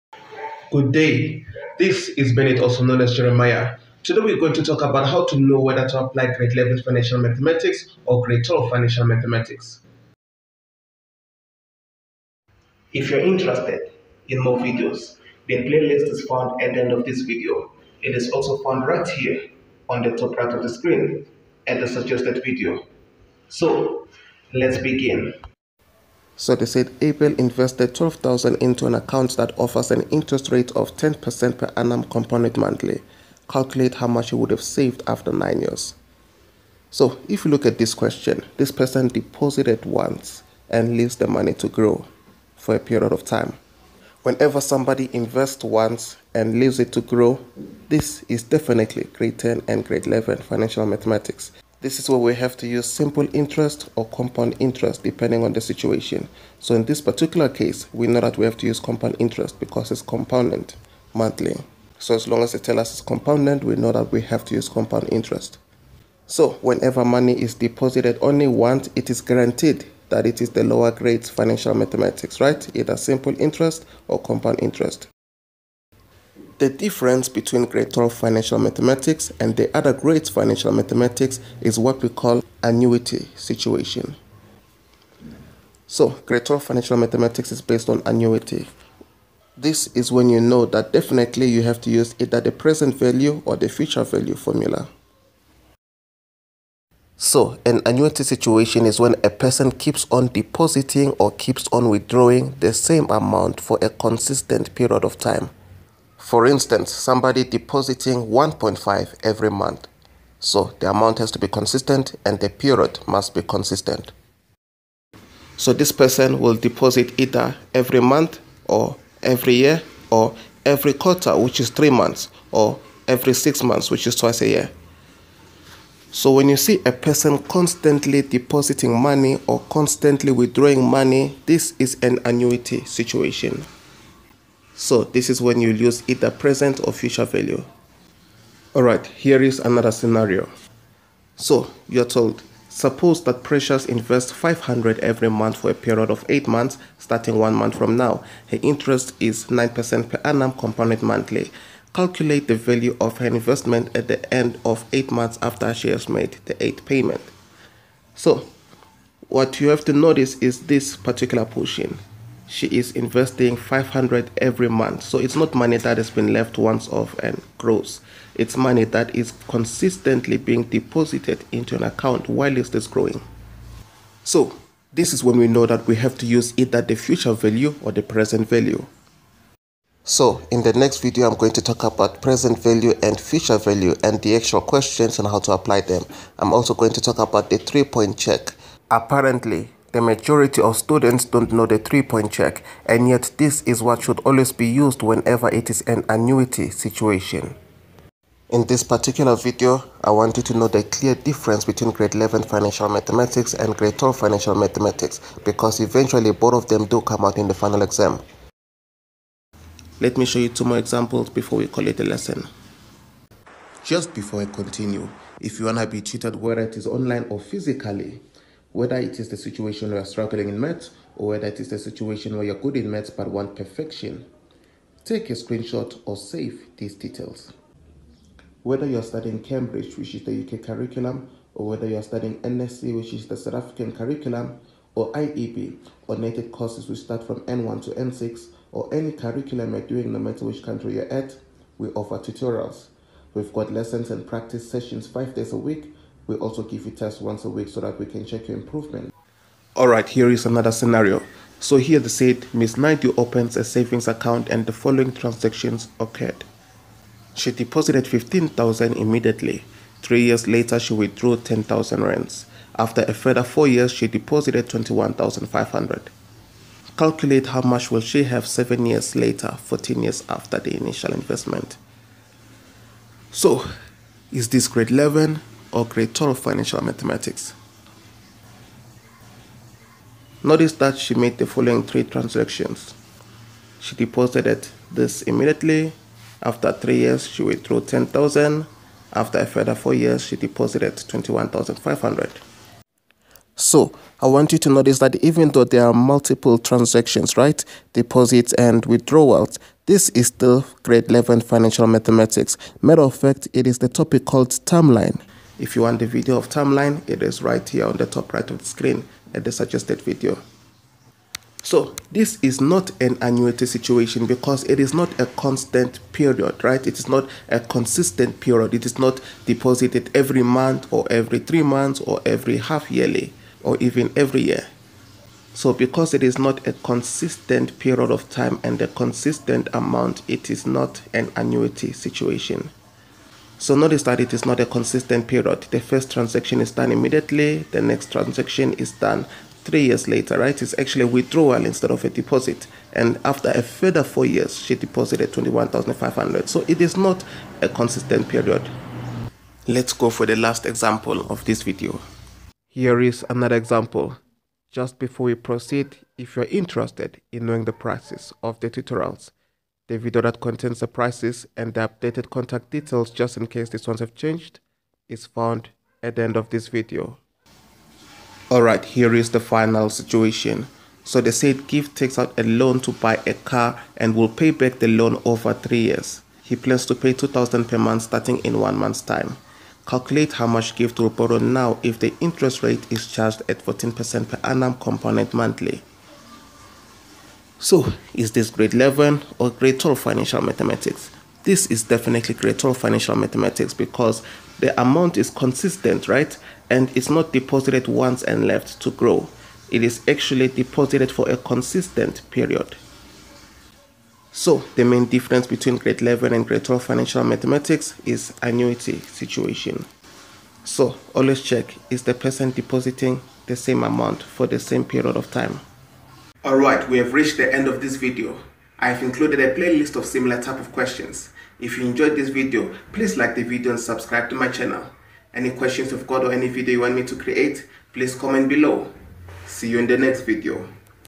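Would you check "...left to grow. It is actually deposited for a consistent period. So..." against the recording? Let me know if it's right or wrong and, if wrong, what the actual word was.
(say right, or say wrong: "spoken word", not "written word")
right.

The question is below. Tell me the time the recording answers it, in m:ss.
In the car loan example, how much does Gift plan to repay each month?
6:17.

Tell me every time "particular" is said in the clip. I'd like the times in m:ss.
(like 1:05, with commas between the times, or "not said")
0:57, 2:40, 3:18.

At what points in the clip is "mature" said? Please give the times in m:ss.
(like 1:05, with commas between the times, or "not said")
not said.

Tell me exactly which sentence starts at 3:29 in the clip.
Let me show you two more examples before we call it a lesson.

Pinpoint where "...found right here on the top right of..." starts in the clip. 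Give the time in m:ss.
0:18.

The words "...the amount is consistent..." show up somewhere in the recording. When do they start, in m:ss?
6:34.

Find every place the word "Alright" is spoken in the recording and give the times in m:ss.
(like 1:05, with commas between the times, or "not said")
2:18, 6:08, 6:56.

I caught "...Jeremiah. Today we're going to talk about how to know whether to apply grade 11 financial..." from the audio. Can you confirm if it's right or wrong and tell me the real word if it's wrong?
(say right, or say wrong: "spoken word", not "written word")
right.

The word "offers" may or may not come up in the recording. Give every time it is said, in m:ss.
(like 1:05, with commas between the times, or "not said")
0:29, 4:01.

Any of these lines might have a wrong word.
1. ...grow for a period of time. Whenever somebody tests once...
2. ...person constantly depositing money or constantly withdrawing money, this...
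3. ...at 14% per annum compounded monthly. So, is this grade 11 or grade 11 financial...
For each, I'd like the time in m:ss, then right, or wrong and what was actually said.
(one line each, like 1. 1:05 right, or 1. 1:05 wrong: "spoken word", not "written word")
1. 0:41 wrong: "invests", not "tests"
2. 2:06 right
3. 6:23 wrong: "12", not "11".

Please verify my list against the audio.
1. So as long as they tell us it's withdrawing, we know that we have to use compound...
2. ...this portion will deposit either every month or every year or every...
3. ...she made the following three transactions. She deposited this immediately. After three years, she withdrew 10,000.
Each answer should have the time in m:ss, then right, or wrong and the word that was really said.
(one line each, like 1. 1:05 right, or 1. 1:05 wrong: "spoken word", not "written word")
1. 1:01 wrong: "compounding", not "withdrawing"
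2. 1:55 wrong: "person", not "portion"
3. 4:40 right.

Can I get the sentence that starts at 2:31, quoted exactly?
Calculate the value of her investment at the end of 8 months after she has made the 8th payment.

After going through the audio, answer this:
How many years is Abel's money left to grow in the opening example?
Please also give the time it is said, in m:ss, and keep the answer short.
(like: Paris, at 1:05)
9 years, at 0:35.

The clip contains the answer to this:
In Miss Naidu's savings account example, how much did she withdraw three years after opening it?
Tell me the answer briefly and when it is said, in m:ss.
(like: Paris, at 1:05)
10,000 rands, at 4:21.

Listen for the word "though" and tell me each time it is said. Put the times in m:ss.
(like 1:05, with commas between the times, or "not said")
4:55.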